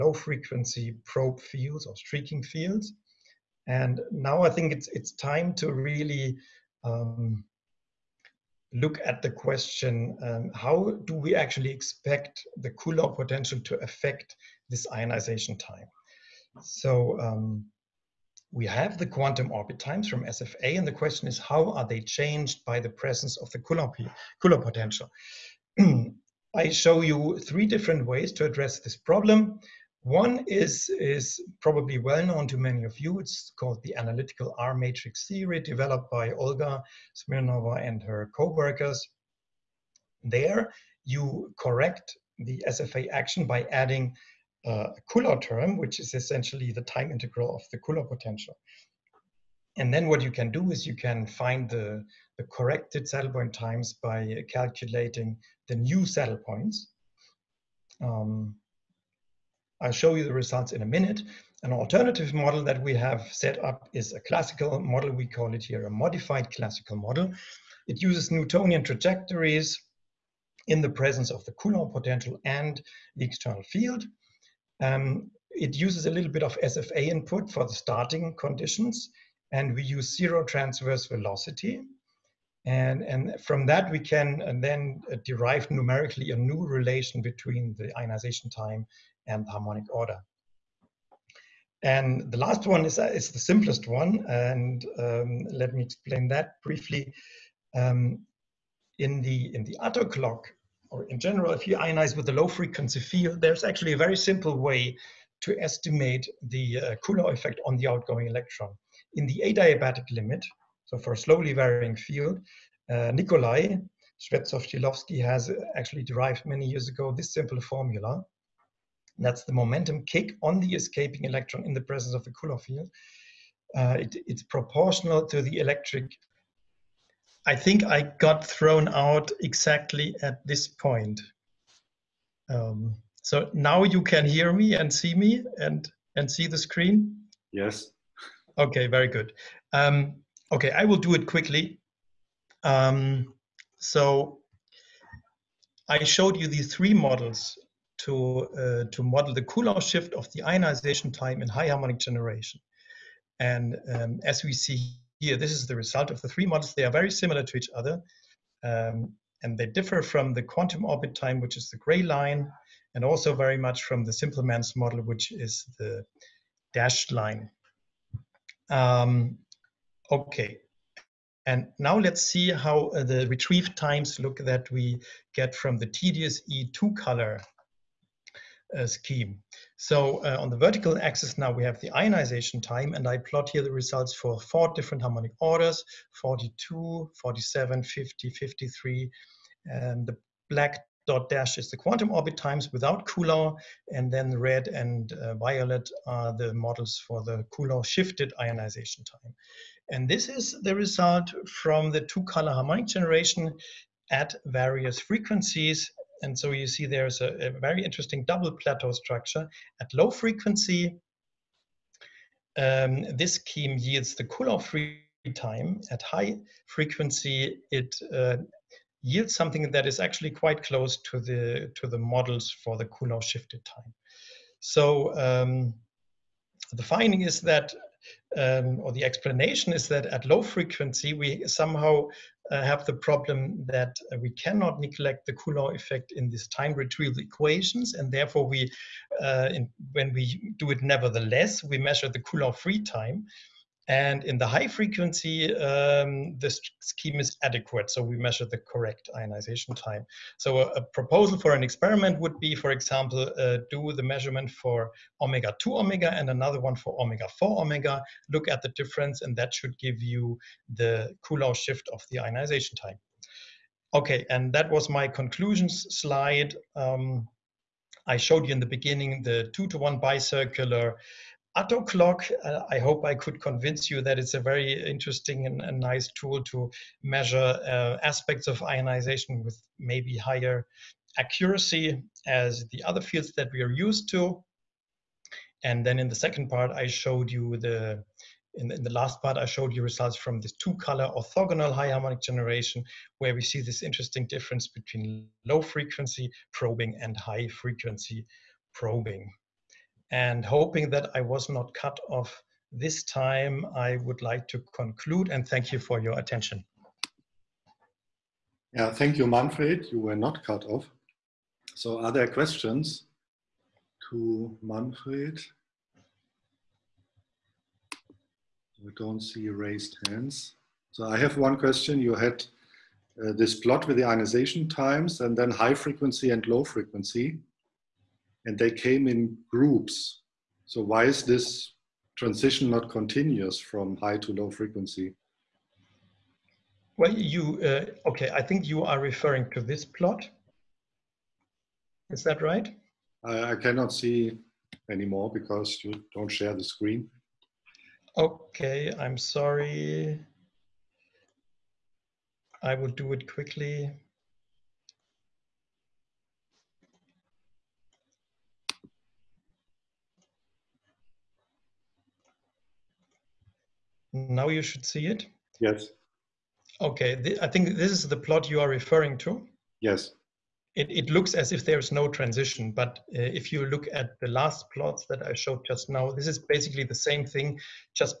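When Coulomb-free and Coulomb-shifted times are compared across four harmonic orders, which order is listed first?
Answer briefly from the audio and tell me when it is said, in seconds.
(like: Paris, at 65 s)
42, at 186 s.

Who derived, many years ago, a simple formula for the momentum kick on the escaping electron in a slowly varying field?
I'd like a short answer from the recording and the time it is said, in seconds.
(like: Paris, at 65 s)
Nikolai Shvetsov-Shilovski, at 113 s.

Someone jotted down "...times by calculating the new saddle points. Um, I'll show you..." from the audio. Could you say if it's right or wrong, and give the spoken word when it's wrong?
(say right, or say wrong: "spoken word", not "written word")
right.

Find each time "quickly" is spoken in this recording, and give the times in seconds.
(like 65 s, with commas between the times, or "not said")
141 s, 353 s.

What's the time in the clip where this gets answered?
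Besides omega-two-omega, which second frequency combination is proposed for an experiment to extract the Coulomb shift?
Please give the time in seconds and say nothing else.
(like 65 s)
257 s.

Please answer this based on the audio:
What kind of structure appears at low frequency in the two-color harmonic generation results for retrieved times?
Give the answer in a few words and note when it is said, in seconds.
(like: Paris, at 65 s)
double plateau structure, at 208 s.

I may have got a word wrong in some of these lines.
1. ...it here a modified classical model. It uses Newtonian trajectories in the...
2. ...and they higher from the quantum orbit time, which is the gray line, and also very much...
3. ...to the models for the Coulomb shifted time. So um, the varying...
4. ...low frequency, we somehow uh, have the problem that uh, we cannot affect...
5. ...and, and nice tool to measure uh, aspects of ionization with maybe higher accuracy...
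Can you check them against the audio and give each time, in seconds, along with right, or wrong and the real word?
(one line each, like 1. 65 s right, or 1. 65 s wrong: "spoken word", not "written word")
1. 65 s right
2. 159 s wrong: "differ", not "higher"
3. 221 s wrong: "finding", not "varying"
4. 230 s wrong: "neglect", not "affect"
5. 275 s right.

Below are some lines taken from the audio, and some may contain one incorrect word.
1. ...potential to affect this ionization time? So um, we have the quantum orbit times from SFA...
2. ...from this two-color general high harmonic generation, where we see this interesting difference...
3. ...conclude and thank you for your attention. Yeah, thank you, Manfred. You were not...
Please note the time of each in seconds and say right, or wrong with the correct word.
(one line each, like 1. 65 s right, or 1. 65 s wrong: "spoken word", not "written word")
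1. 13 s right
2. 290 s wrong: "orthogonal", not "general"
3. 304 s right.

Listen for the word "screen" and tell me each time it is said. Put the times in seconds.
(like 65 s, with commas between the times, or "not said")
136 s, 346 s.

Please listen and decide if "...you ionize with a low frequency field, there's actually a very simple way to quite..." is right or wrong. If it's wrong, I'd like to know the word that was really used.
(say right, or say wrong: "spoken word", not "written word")
wrong: "estimate", not "quite".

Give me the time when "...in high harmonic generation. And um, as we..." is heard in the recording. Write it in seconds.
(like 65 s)
151 s.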